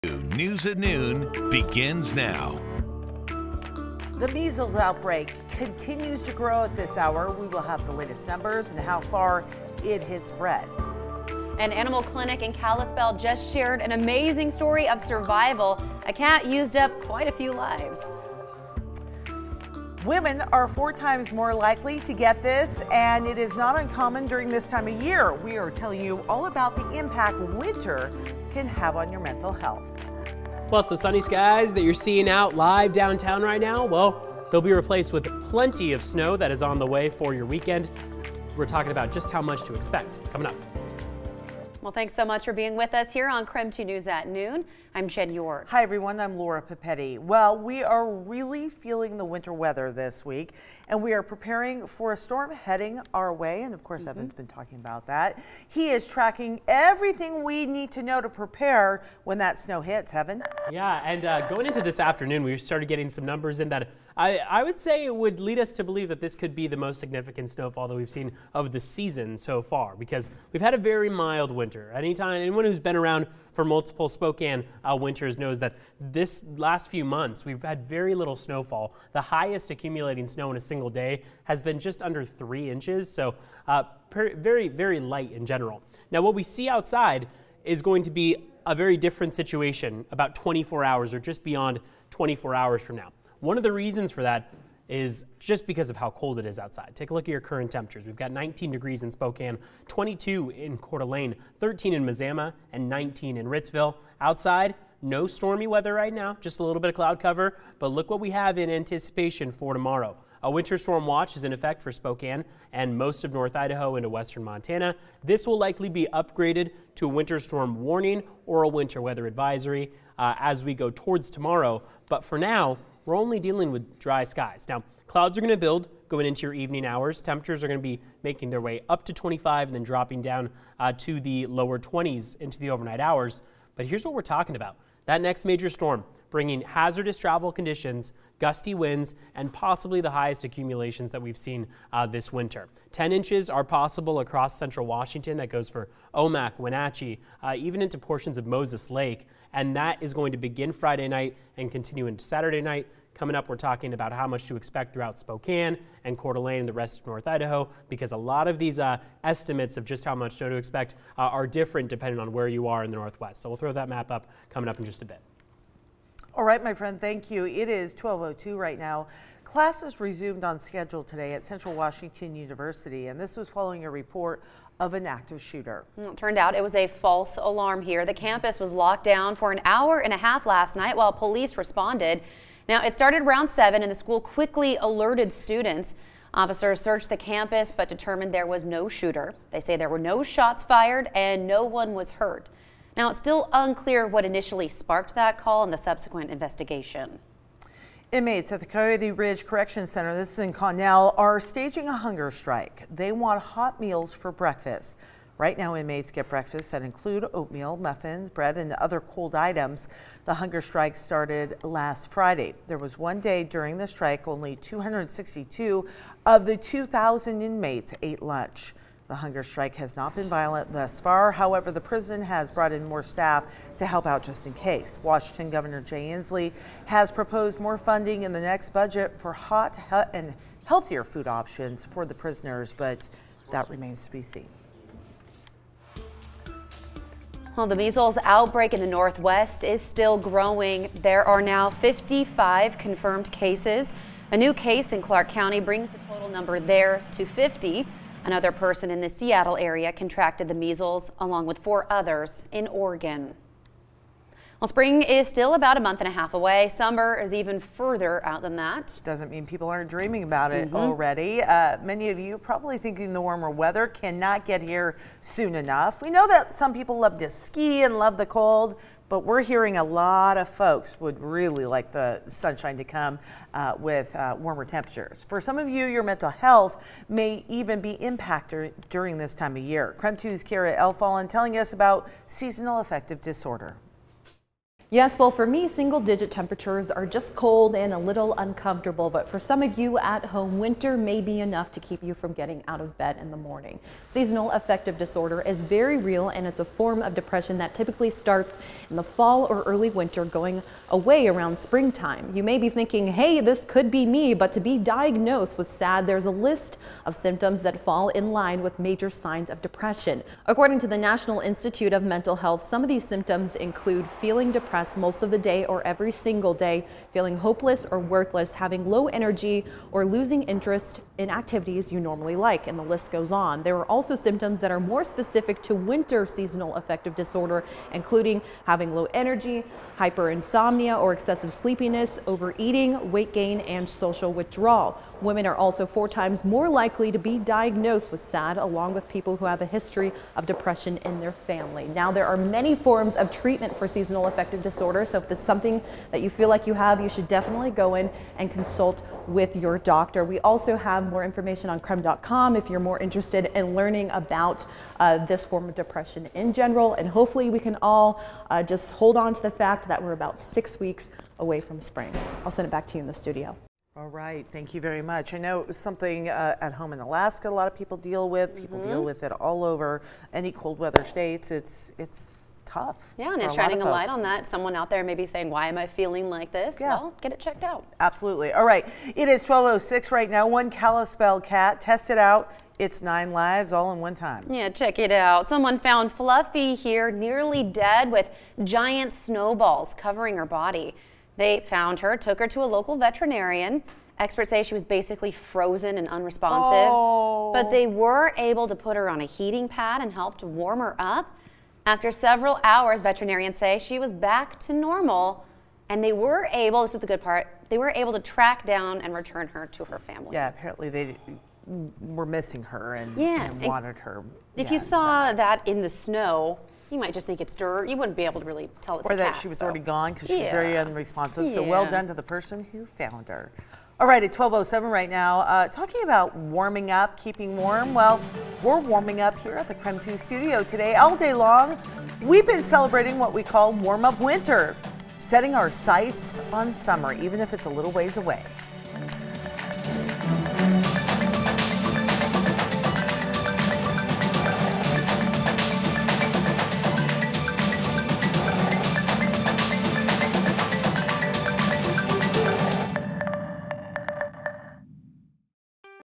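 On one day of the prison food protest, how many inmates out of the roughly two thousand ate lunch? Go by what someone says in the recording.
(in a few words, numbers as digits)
262.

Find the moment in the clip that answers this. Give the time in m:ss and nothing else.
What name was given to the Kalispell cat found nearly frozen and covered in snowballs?
6:26.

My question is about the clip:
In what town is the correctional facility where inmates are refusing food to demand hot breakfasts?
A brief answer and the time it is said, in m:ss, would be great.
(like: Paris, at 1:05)
Connell, at 3:20.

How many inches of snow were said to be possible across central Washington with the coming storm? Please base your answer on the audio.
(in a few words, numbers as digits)
10 inches.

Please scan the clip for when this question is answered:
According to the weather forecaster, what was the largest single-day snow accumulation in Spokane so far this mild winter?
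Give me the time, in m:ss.
1:21.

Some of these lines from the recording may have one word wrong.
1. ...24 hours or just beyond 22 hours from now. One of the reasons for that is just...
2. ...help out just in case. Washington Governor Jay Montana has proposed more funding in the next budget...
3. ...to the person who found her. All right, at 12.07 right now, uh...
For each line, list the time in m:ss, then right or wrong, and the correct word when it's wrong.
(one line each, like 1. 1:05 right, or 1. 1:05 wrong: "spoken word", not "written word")
1. 1:30 wrong: "24", not "22"
2. 3:43 wrong: "Inslee", not "Montana"
3. 7:02 right.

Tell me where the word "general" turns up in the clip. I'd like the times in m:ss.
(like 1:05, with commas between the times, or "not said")
1:25, 5:56.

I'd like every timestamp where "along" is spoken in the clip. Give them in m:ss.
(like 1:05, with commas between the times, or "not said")
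4:11, 5:38.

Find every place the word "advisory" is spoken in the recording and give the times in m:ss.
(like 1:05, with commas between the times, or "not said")
1:59.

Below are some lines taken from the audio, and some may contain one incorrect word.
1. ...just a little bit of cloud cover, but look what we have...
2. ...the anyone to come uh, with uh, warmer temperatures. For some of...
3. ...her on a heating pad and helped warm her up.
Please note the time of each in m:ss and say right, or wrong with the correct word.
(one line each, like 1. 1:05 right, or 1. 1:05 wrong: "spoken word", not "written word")
1. 1:46 right
2. 4:31 wrong: "sunshine", not "anyone"
3. 6:38 right.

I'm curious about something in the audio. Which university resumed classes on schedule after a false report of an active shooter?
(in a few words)
Central Washington University.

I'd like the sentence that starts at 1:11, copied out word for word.
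Anytime, anyone who's been around for multiple Spokane uh, winters knows that this last few months we've had very little snowfall.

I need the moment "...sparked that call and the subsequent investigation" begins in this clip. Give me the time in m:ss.
3:14.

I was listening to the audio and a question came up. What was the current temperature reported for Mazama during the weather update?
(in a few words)
13 degrees.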